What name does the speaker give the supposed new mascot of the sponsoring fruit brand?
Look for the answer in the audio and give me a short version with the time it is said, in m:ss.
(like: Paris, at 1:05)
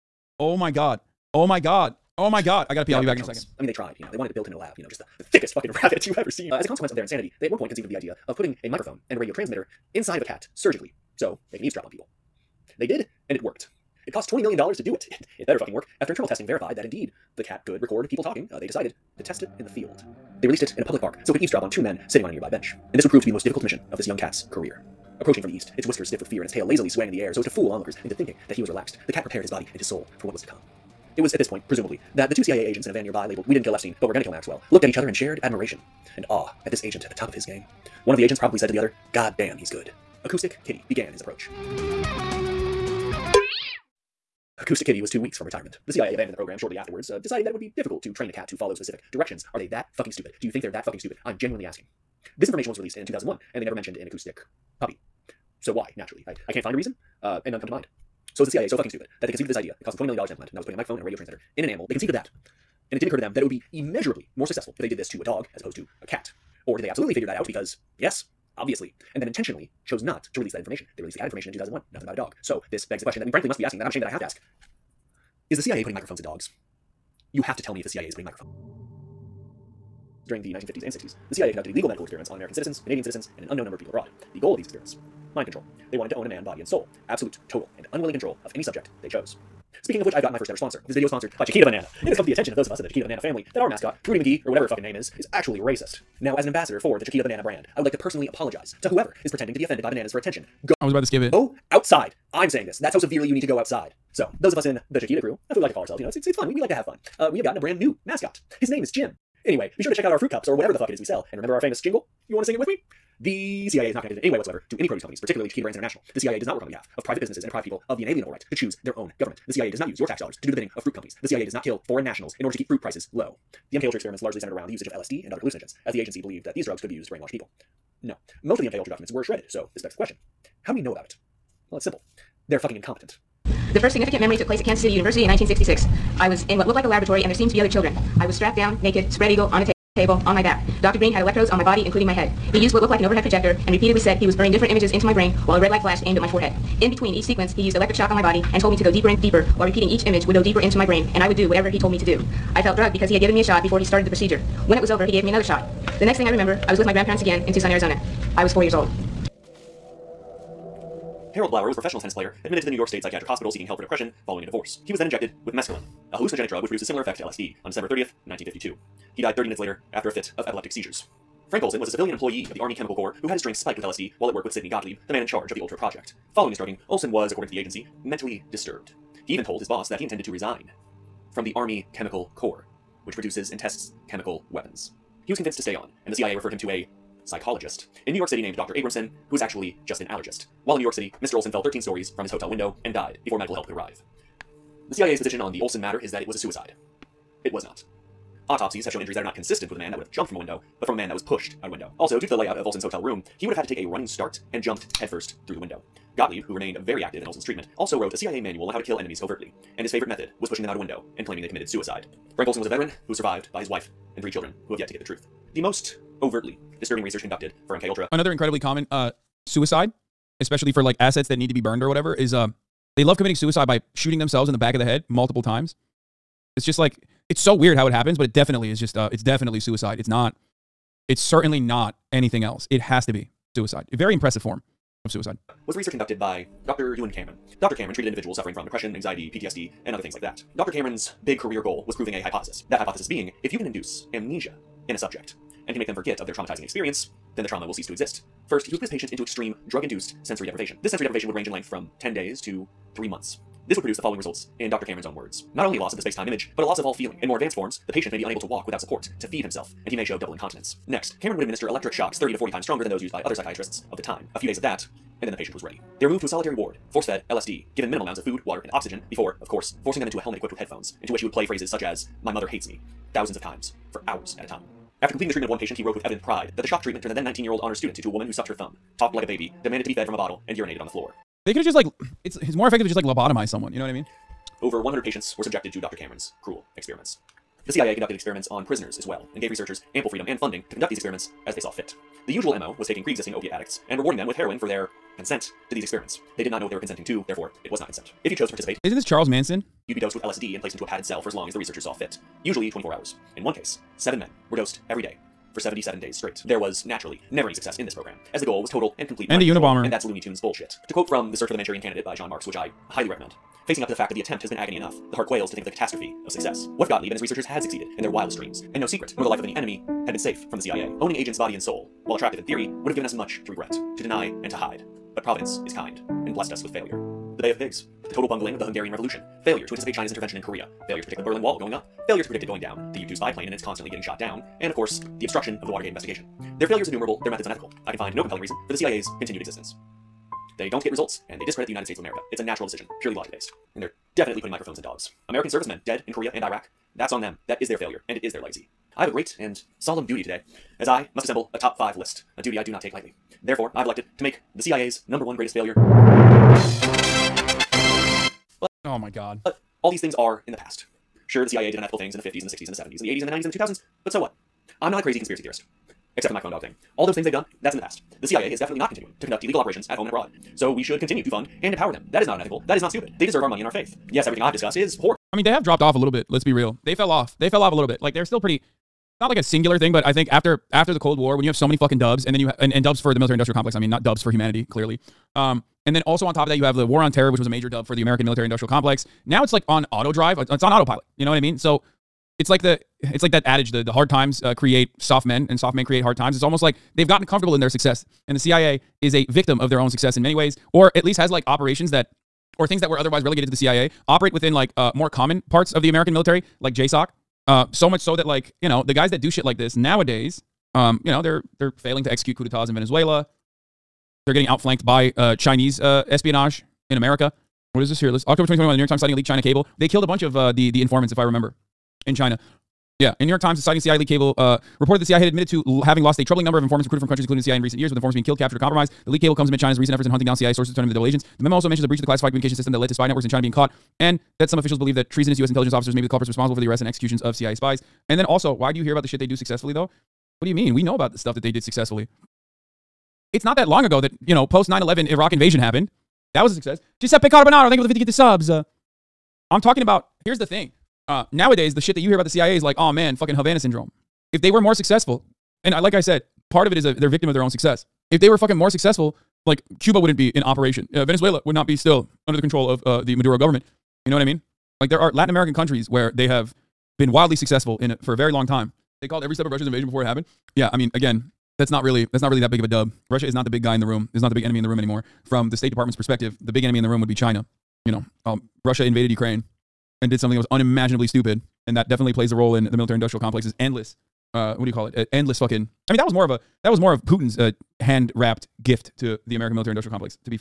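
Jim, at 1:48.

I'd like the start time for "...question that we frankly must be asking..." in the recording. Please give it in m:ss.
1:13.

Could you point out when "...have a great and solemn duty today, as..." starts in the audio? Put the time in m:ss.
5:49.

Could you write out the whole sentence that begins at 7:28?
Uh, I'm talking about, here's the thing.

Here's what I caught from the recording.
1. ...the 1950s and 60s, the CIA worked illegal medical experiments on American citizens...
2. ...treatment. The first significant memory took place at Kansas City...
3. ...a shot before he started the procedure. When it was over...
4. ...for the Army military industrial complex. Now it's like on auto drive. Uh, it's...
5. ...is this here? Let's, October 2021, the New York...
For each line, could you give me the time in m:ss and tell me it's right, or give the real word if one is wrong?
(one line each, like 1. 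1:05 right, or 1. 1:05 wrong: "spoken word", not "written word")
1. 1:20 wrong: "conducted", not "worked"
2. 2:12 wrong: "incompetent", not "treatment"
3. 2:33 right
4. 6:27 wrong: "American", not "Army"
5. 6:57 right.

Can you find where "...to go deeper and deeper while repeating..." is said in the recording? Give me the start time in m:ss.
2:28.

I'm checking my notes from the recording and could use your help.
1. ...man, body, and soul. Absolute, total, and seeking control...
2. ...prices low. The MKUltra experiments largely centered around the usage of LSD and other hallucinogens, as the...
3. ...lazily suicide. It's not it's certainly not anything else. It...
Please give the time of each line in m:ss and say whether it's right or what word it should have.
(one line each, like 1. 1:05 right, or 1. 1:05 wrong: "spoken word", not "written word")
1. 1:26 wrong: "unwilling", not "seeking"
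2. 2:02 right
3. 3:49 wrong: "definitely", not "lazily".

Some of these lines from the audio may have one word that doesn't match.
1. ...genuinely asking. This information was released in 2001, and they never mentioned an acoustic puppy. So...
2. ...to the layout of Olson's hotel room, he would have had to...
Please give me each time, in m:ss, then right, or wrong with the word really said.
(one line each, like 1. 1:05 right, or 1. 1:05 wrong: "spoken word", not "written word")
1. 0:51 right
2. 3:22 right.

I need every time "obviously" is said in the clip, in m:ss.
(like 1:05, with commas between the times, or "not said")
1:08.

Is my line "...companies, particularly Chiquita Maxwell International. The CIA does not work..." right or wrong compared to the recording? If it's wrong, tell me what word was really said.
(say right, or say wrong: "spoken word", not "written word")
wrong: "Brands", not "Maxwell".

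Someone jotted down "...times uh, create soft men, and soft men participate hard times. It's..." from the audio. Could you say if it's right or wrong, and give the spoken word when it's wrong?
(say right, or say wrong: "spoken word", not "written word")
wrong: "create", not "participate".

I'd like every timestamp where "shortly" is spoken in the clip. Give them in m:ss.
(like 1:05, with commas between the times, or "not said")
0:46.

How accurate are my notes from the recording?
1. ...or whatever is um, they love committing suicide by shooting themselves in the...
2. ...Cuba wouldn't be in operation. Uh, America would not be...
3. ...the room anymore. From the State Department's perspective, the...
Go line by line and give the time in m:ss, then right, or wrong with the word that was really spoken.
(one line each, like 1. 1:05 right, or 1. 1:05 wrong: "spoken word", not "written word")
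1. 3:41 right
2. 7:39 wrong: "Venezuela", not "America"
3. 7:54 right.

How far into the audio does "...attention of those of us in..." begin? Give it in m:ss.
1:32.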